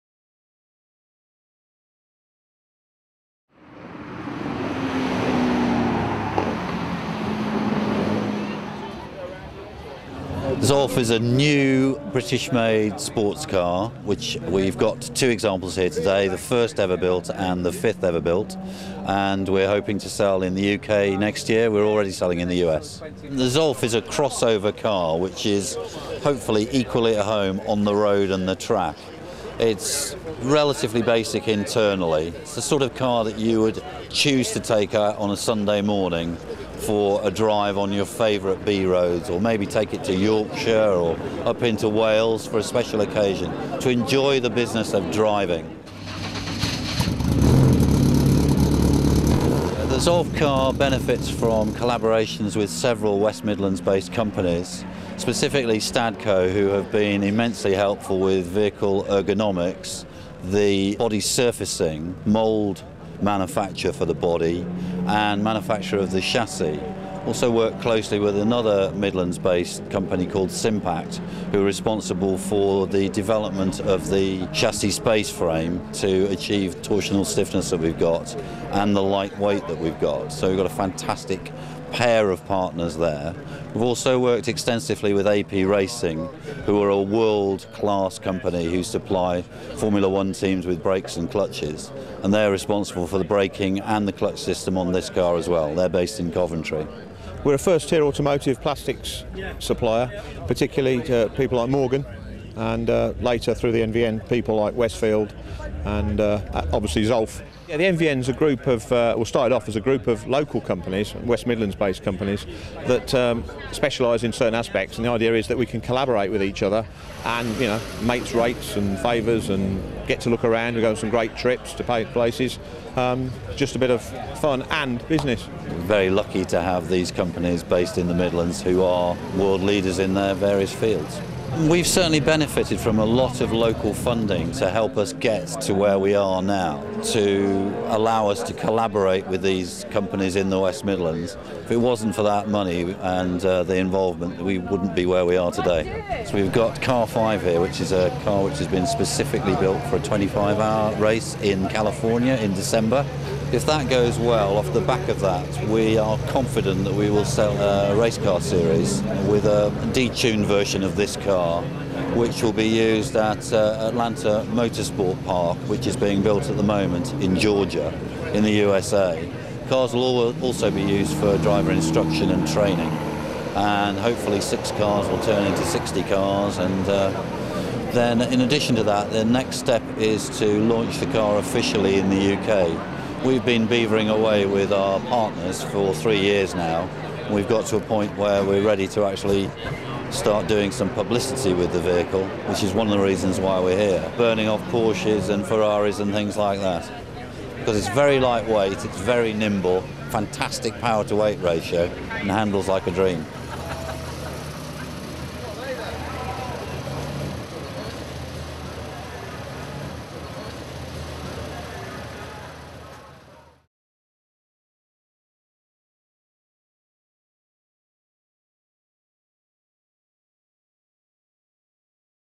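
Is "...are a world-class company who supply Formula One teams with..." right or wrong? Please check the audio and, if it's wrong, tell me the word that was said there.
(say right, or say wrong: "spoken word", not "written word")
right.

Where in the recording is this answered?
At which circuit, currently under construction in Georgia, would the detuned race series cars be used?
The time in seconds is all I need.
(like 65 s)
163 s.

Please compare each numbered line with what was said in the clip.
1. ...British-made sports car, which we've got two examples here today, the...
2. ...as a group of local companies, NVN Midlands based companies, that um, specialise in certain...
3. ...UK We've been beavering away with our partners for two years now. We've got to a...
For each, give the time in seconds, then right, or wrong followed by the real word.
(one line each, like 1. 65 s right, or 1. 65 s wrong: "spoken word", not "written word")
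1. 12 s right
2. 109 s wrong: "West", not "NVN"
3. 182 s wrong: "three", not "two".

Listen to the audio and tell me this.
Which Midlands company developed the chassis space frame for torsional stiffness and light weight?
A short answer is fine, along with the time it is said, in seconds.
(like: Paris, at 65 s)
Simpact, at 70 s.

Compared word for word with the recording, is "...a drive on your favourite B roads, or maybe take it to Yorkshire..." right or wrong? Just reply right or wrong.
right.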